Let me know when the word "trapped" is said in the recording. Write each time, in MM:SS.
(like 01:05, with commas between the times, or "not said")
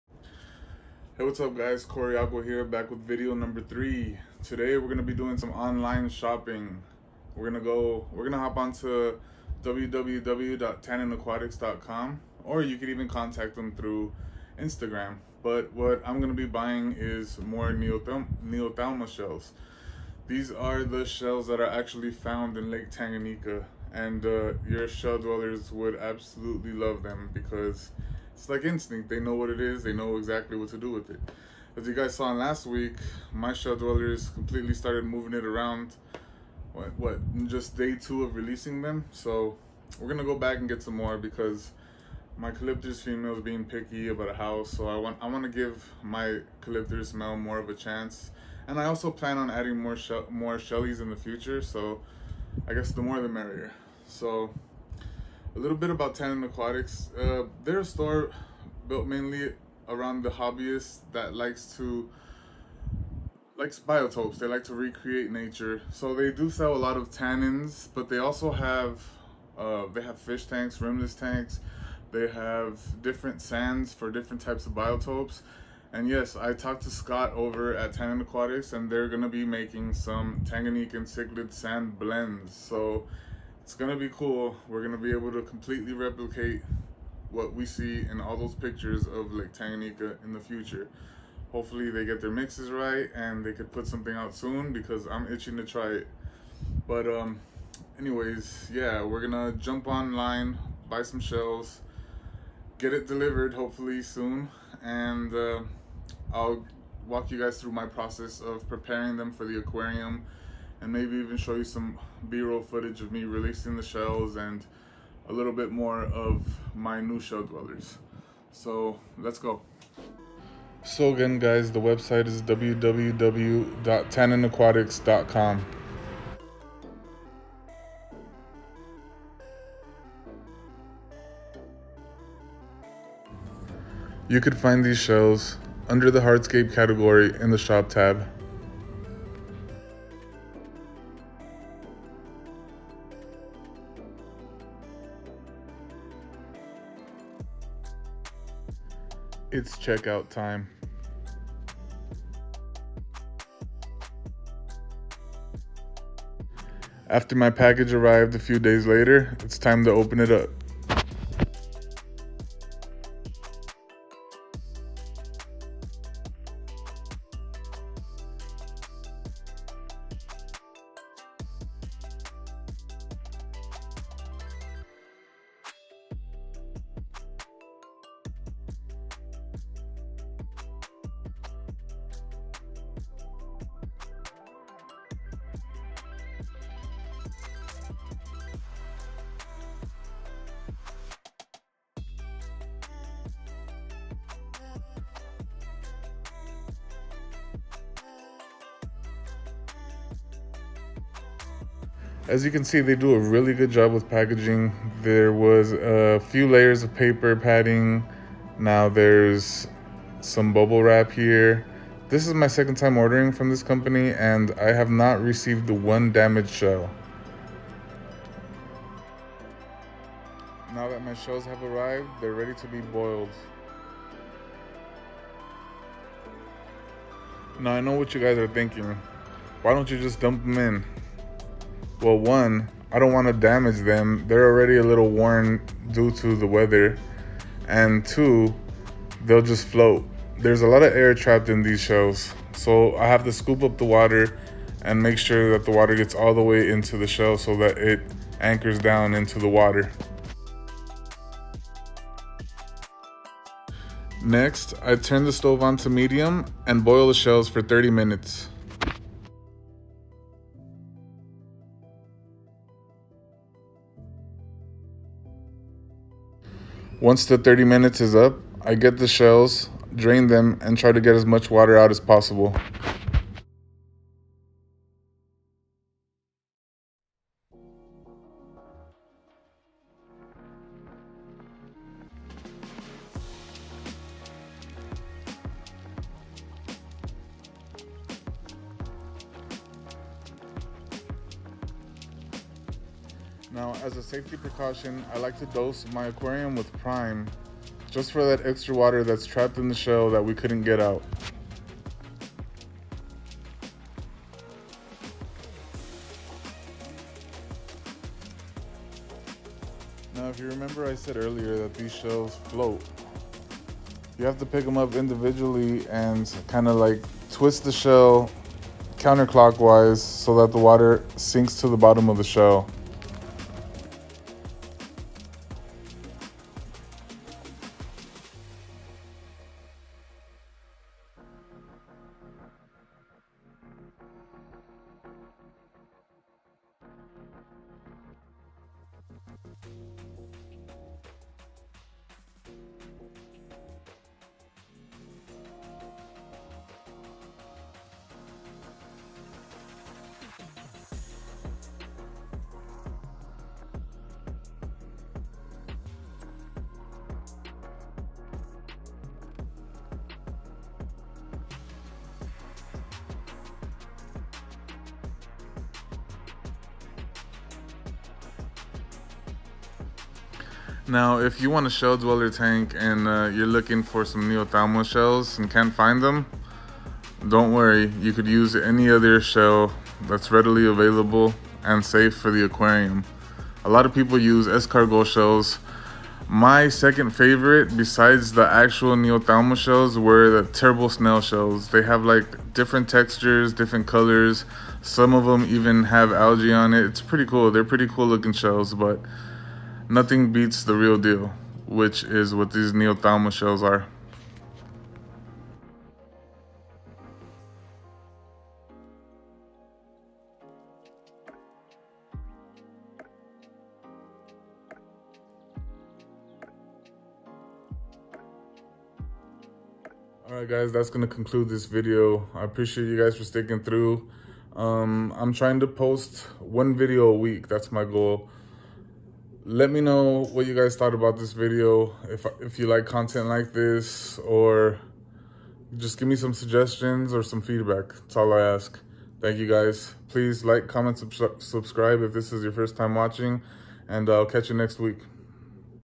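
04:01, 04:59.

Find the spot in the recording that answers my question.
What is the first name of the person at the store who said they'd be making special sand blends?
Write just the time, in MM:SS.
01:16.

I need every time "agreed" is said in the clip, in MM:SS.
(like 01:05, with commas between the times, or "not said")
not said.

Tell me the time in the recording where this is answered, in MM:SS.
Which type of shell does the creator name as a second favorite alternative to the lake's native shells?
06:30.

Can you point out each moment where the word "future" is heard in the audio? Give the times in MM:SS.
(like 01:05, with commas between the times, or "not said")
00:51, 01:30.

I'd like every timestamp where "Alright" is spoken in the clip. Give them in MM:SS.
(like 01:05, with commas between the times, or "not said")
07:00.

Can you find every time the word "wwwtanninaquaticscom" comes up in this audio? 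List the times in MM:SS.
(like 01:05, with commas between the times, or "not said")
00:09, 02:02.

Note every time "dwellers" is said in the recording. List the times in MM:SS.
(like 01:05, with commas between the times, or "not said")
00:25, 00:33, 01:57, 06:11.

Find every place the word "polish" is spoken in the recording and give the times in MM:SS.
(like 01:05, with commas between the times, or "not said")
not said.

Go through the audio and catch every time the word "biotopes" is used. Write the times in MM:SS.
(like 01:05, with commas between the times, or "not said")
01:03, 01:14.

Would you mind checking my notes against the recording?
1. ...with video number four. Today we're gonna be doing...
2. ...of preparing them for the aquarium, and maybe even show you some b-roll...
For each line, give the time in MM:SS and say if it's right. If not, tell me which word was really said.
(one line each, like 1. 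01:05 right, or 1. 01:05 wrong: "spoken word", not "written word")
1. 00:02 wrong: "three", not "four"
2. 01:48 right.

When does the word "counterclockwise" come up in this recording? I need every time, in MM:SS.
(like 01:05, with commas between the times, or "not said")
05:18.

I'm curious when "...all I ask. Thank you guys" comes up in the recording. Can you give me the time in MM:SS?
07:18.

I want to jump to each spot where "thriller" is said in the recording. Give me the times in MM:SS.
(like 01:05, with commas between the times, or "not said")
not said.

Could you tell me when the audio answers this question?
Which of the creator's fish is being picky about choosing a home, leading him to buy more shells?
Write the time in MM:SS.
00:42.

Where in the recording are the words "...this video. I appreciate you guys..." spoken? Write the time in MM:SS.
07:01.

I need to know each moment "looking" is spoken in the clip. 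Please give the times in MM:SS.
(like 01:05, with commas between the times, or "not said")
06:13, 06:38.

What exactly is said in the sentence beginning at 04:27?
Once the 30 minutes is up, I get the shells, drain them, and try to get as much water out as possible.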